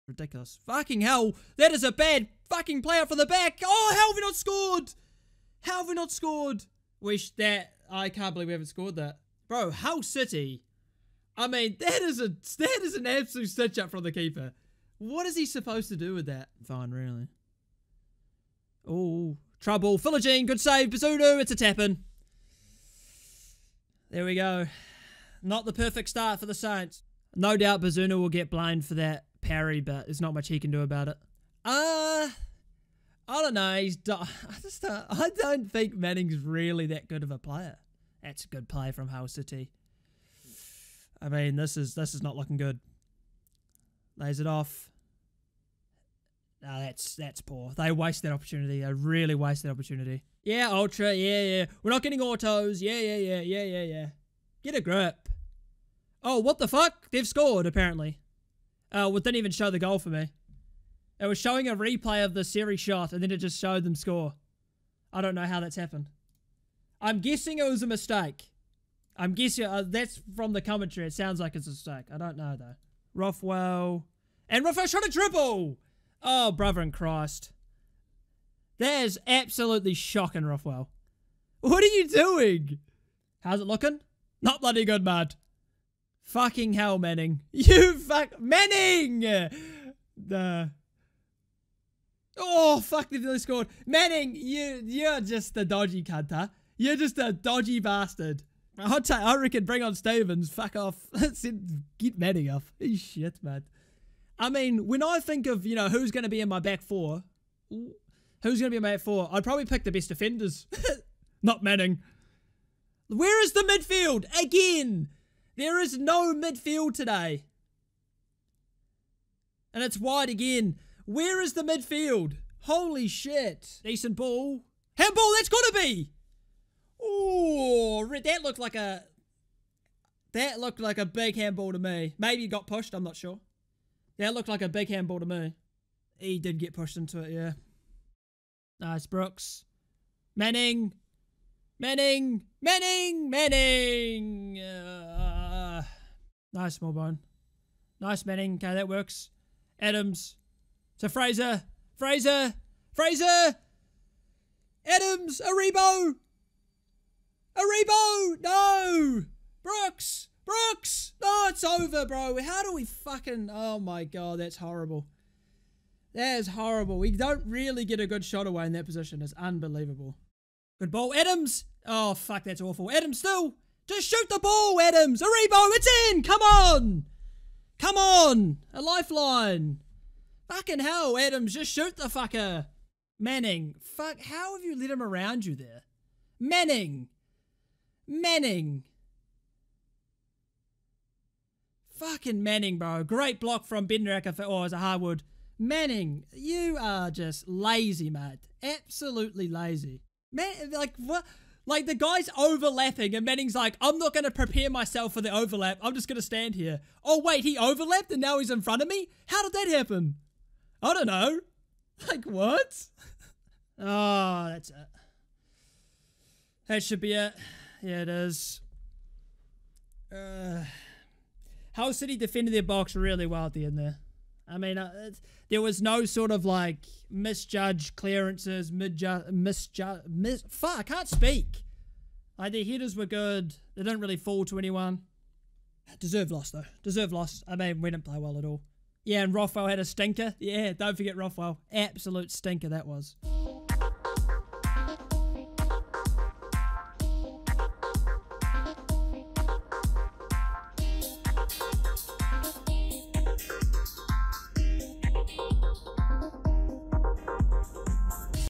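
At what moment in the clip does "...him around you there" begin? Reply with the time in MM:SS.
03:04.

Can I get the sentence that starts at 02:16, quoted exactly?
He did get pushed into it, yeah.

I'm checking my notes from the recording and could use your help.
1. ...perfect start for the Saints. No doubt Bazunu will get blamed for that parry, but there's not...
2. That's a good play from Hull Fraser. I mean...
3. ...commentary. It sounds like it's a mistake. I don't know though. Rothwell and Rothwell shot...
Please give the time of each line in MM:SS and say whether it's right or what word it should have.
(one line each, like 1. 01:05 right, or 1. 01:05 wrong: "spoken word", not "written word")
1. 00:25 right
2. 00:38 wrong: "City", not "Fraser"
3. 01:10 right.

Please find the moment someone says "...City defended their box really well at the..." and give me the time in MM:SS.
03:41.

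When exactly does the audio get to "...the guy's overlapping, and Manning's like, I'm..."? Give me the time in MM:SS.
03:21.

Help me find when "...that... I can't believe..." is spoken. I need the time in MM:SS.
00:07.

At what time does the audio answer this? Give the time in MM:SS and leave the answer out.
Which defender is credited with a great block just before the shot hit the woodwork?
03:13.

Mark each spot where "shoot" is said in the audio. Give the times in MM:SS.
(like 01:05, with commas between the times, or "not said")
02:54, 03:01.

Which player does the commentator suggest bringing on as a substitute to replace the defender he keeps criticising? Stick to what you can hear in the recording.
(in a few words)
Stephens.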